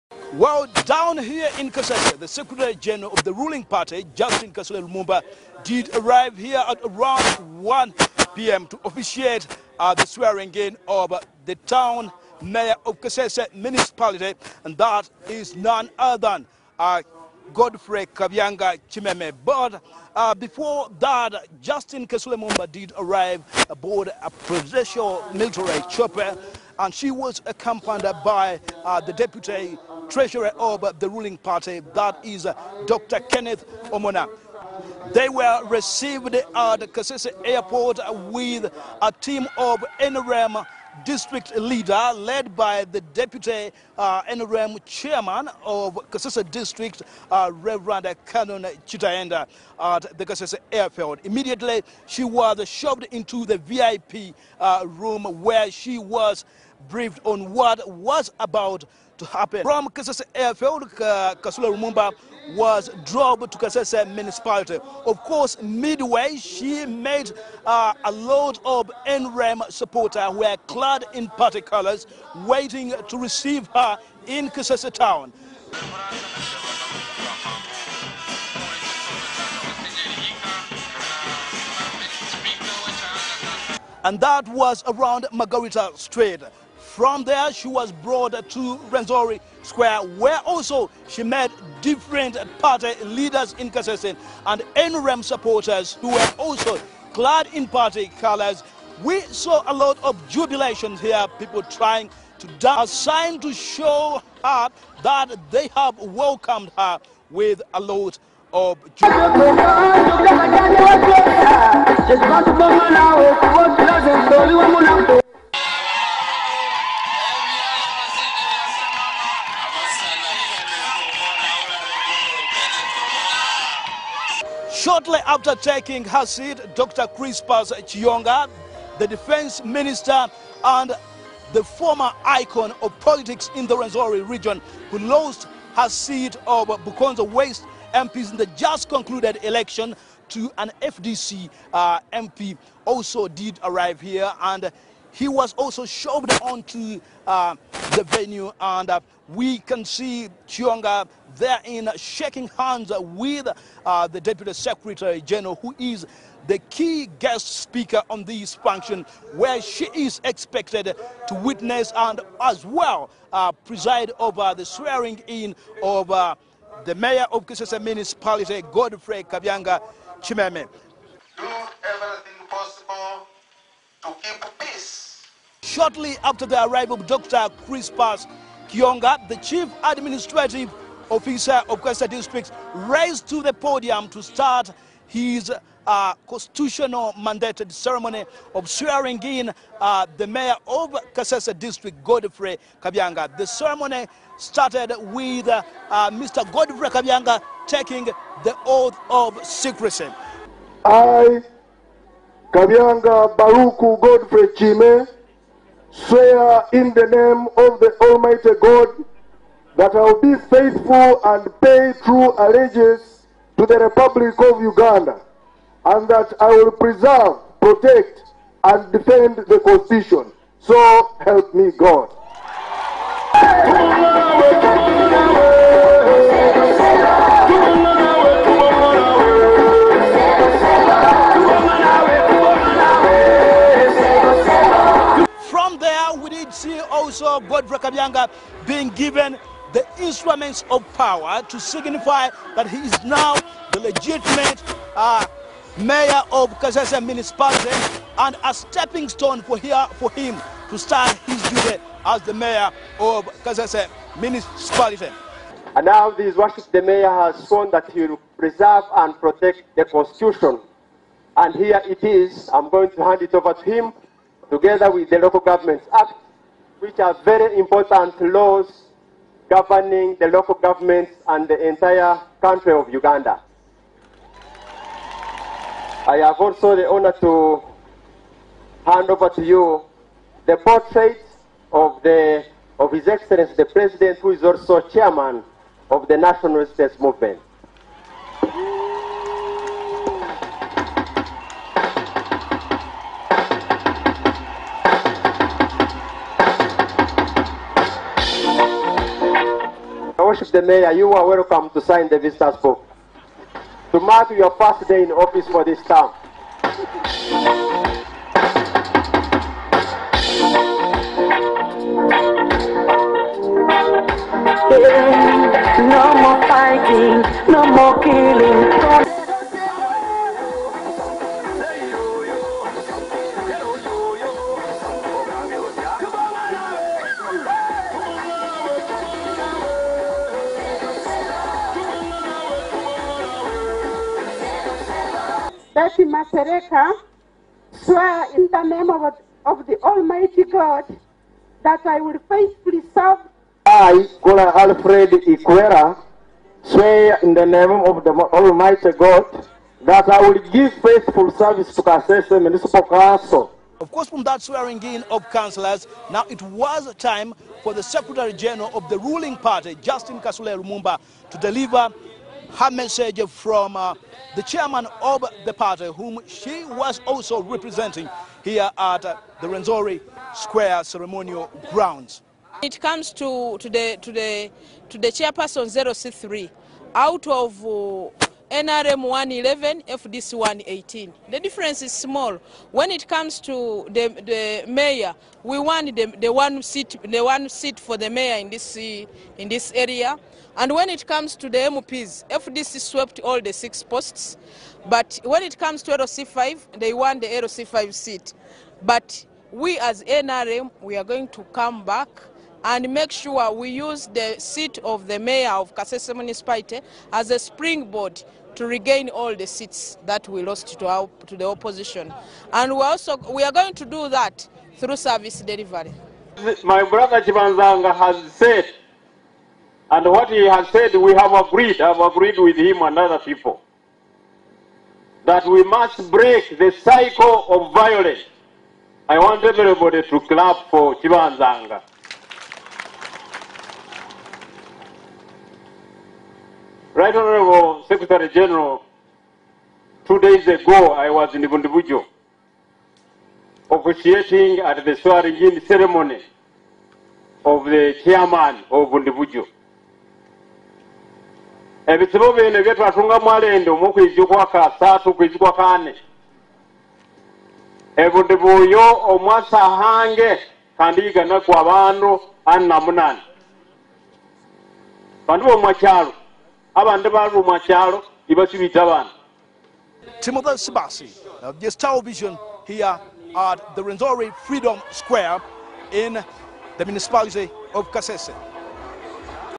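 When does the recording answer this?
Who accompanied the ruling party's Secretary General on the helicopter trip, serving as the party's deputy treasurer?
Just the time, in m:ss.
0:32.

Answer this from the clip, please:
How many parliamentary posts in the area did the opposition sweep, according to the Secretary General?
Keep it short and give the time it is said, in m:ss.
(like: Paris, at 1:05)
6, at 6:33.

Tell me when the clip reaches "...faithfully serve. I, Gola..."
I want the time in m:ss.
5:42.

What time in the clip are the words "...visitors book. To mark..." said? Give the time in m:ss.
5:02.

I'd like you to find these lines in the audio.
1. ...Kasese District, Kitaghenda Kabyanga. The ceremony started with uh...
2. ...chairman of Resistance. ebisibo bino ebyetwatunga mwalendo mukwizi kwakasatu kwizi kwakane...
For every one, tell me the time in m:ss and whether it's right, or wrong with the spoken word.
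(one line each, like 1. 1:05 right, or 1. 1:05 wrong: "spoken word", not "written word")
1. 3:11 wrong: "Godfrey", not "Kitaghenda"
2. 7:28 wrong: "Bundibujo", not "Resistance".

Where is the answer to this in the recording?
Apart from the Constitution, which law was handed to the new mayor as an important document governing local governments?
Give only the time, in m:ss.
4:25.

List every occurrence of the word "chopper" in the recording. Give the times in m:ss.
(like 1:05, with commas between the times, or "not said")
0:25.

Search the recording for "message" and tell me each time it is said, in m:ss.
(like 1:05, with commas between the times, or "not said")
6:02.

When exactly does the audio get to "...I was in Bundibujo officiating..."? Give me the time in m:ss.
7:20.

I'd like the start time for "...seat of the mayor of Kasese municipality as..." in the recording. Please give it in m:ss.
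6:44.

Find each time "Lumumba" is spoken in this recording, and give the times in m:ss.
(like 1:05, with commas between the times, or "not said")
0:04, 1:01, 6:00.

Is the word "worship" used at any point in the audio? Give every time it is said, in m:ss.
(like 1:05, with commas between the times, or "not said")
4:16, 5:00.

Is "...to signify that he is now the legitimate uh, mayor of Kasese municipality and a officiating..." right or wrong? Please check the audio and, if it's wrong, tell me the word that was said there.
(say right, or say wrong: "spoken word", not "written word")
wrong: "stepping", not "officiating".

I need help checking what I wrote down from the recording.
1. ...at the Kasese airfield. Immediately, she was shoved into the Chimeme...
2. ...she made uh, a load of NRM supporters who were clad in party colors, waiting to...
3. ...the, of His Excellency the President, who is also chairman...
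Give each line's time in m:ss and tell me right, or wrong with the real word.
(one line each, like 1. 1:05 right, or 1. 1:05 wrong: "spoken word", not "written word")
1. 0:49 wrong: "VIP", not "Chimeme"
2. 1:06 right
3. 4:42 right.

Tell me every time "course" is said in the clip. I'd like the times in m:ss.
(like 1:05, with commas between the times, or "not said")
1:05, 5:53.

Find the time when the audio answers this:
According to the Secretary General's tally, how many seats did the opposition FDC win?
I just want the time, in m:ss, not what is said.
6:19.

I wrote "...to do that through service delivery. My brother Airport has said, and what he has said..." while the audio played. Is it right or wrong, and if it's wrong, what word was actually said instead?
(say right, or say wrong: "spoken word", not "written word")
wrong: "Chibanzanga", not "Airport".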